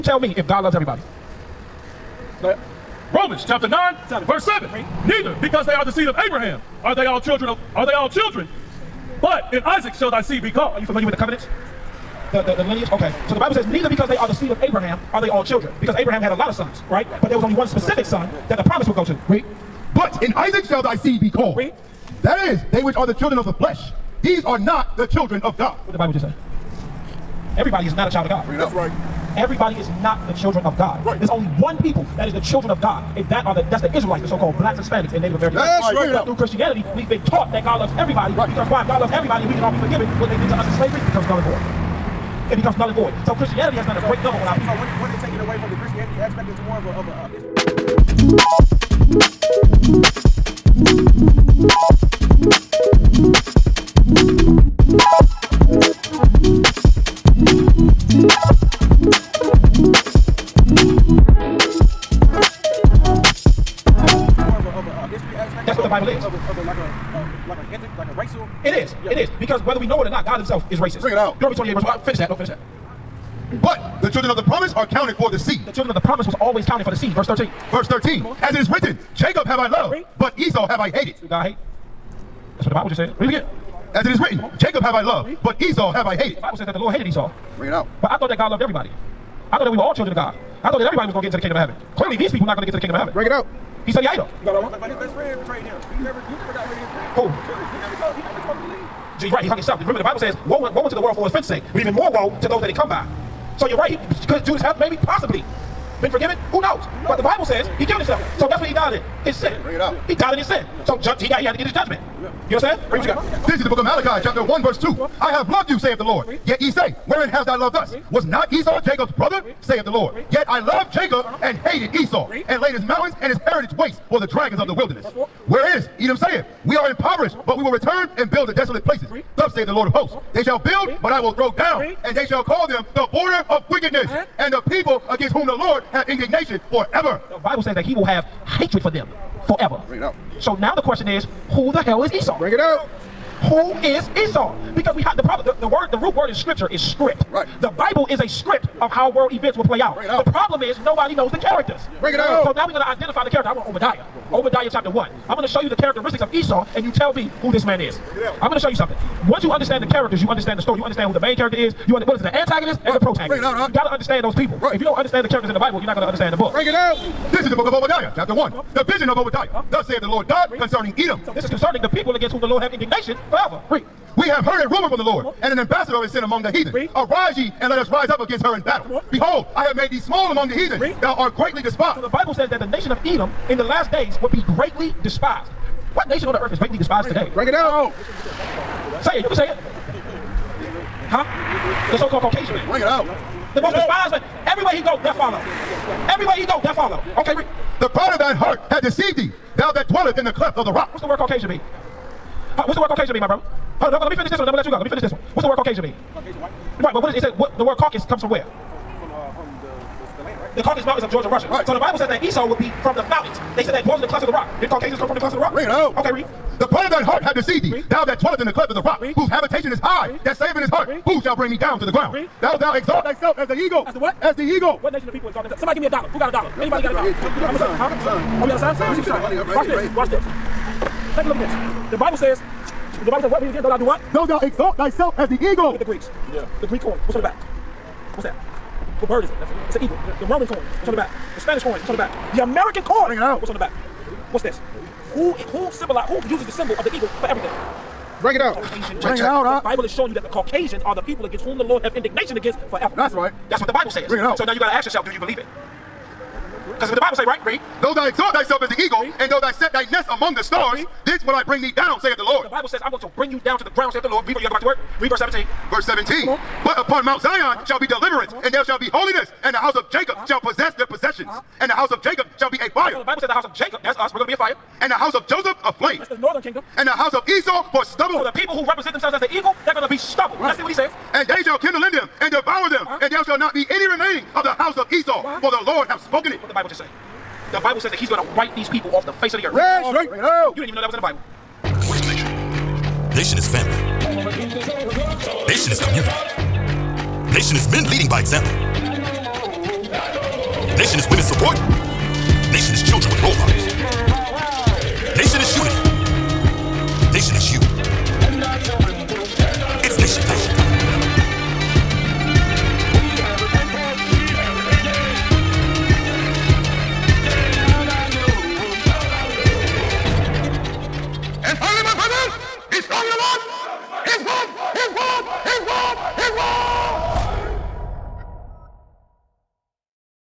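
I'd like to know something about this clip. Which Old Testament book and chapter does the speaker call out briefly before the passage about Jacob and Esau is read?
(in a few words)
Deuteronomy 28.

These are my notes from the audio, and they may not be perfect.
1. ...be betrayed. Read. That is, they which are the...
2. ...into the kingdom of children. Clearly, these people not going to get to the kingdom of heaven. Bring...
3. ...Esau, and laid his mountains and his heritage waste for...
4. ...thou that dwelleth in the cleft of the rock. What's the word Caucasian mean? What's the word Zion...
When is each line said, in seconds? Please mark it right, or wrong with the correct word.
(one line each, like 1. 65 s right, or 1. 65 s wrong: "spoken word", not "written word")
1. 21 s wrong: "called", not "betrayed"
2. 91 s wrong: "heaven", not "children"
3. 121 s right
4. 199 s wrong: "Caucasian", not "Zion".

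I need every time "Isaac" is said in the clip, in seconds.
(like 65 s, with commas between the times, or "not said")
9 s, 20 s.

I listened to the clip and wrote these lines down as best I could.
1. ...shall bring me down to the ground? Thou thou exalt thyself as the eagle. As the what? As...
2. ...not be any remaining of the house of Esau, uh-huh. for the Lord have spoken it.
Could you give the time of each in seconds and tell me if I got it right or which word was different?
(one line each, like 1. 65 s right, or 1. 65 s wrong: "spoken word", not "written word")
1. 221 s right
2. 283 s right.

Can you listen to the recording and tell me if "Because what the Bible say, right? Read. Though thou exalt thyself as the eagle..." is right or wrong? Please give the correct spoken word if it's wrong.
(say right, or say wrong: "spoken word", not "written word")
right.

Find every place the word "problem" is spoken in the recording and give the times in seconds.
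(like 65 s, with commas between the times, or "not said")
145 s, 150 s.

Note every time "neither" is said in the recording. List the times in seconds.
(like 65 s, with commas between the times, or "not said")
5 s, 13 s.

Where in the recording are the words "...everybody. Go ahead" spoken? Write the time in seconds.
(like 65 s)
0 s.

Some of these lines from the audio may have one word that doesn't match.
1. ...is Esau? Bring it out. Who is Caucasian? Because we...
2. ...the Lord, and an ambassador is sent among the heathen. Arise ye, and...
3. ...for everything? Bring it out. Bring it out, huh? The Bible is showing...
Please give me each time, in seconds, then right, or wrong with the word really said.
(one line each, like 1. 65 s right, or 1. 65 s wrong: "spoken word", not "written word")
1. 142 s wrong: "Esau", not "Caucasian"
2. 174 s right
3. 247 s right.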